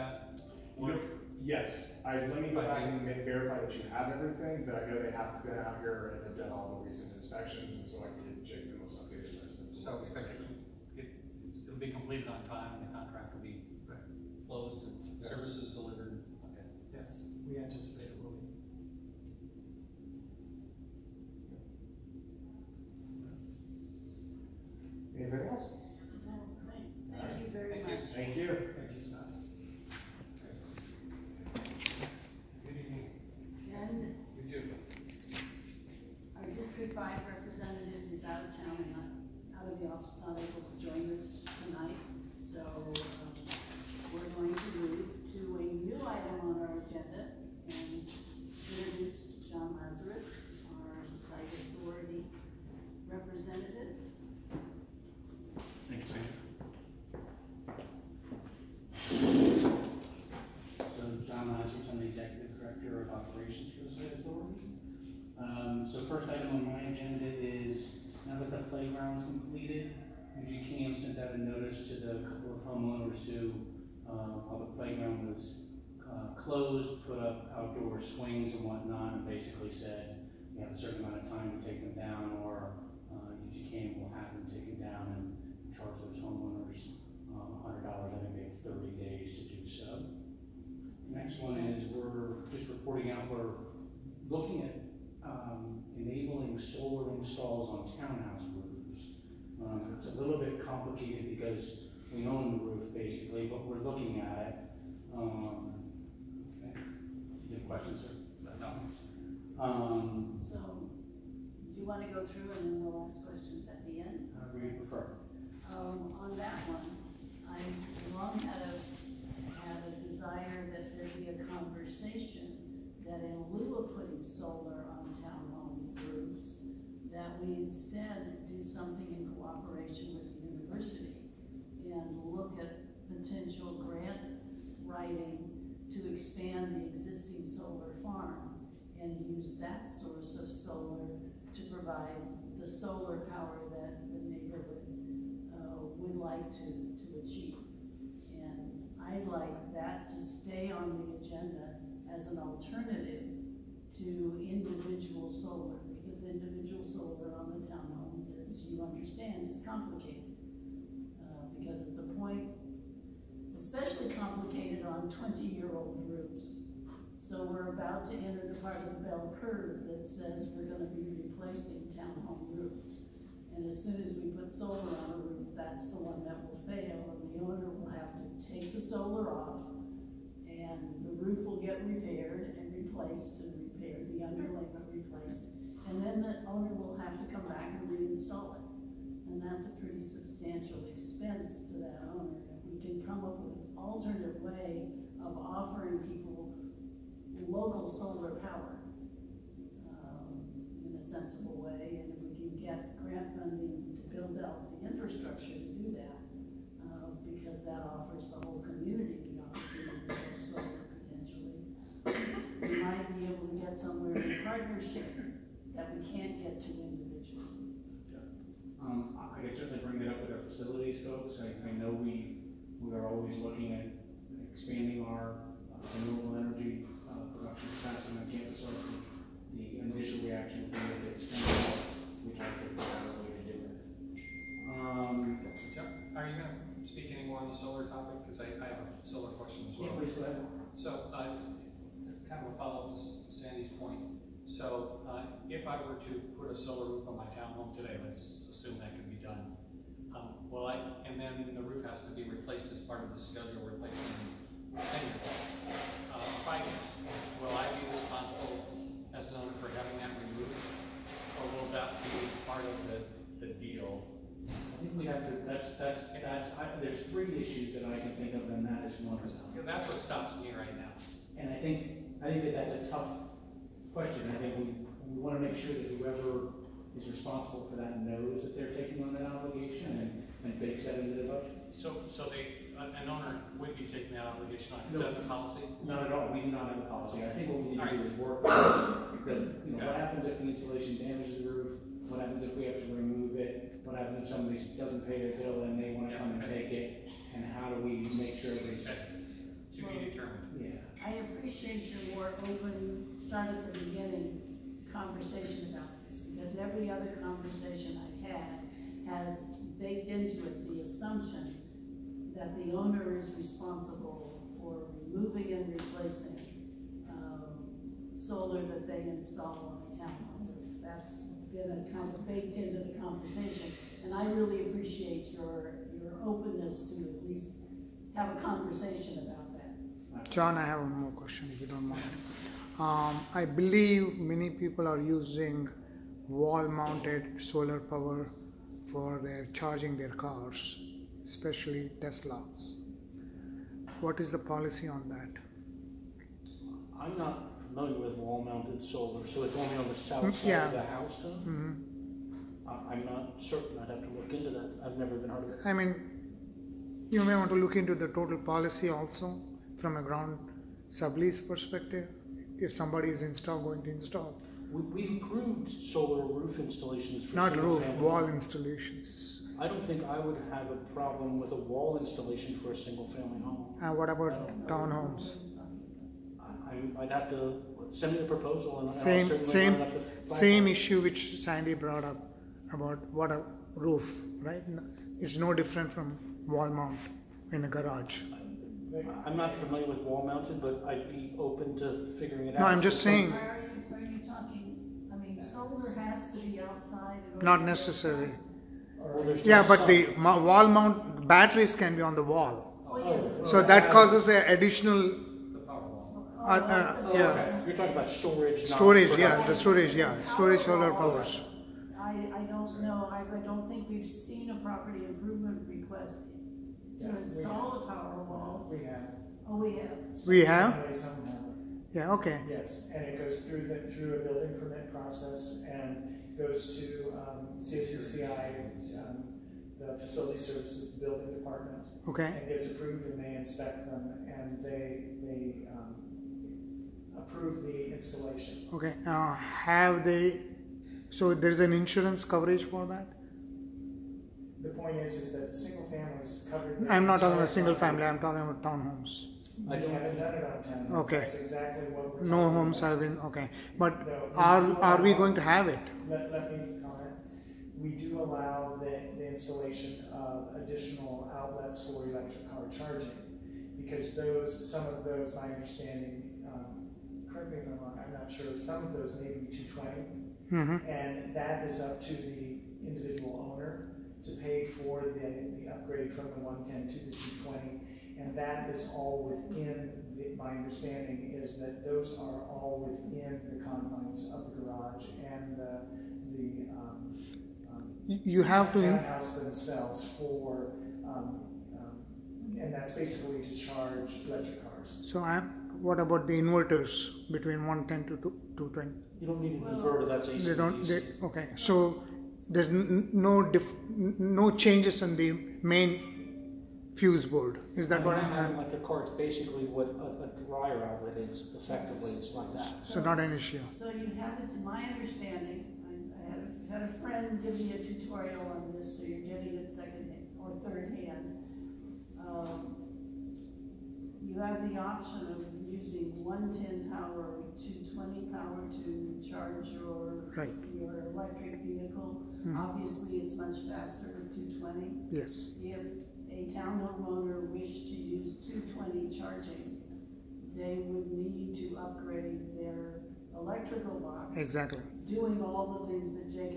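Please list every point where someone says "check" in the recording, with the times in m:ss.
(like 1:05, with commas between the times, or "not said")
0:08.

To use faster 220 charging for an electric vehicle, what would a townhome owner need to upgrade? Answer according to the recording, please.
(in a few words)
electrical box.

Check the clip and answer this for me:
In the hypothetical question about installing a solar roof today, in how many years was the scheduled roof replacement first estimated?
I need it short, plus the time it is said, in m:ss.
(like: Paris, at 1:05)
10 years, at 4:14.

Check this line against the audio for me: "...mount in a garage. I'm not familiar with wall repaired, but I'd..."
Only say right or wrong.
wrong.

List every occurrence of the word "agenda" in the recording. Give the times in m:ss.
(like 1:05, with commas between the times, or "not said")
2:31.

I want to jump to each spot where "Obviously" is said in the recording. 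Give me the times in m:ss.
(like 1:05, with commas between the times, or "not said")
8:52.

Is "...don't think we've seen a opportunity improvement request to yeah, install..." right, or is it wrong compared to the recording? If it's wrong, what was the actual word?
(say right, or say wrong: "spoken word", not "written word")
wrong: "property", not "opportunity".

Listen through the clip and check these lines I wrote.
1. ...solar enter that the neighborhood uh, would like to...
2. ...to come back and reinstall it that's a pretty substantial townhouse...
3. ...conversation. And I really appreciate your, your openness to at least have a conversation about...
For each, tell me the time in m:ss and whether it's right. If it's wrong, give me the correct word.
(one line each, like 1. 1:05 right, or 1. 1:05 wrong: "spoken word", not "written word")
1. 2:22 wrong: "power", not "enter"
2. 3:07 wrong: "expense", not "townhouse"
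3. 5:22 right.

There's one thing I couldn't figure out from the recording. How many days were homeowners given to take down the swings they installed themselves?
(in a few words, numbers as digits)
30 days.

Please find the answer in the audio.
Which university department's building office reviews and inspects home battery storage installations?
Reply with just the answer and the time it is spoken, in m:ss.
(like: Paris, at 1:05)
Facility Services Building Department, at 7:09.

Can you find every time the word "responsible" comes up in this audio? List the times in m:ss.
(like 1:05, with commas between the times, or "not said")
4:17, 4:37, 5:13.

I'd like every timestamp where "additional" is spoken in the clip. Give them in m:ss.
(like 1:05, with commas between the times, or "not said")
6:44, 7:40.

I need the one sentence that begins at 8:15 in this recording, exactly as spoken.
So i what about the inverters between 110 to 220?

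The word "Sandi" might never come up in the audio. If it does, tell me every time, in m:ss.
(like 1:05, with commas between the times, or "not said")
4:03, 6:21.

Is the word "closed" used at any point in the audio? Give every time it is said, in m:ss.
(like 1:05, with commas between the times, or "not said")
0:14, 1:16.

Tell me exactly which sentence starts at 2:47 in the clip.
So we're about to enter the part of the bell curve that says we're going to be replacing townhome roofs.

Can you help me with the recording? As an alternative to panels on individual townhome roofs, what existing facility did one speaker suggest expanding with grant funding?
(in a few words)
solar farm.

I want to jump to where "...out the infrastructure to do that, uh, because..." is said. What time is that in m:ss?
3:24.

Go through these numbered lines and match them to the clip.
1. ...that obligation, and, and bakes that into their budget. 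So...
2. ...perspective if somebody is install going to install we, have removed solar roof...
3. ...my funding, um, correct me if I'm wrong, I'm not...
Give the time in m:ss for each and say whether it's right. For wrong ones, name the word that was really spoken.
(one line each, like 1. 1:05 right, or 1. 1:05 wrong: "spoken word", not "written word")
1. 4:39 right
2. 6:01 wrong: "approved", not "removed"
3. 7:45 wrong: "understanding", not "funding".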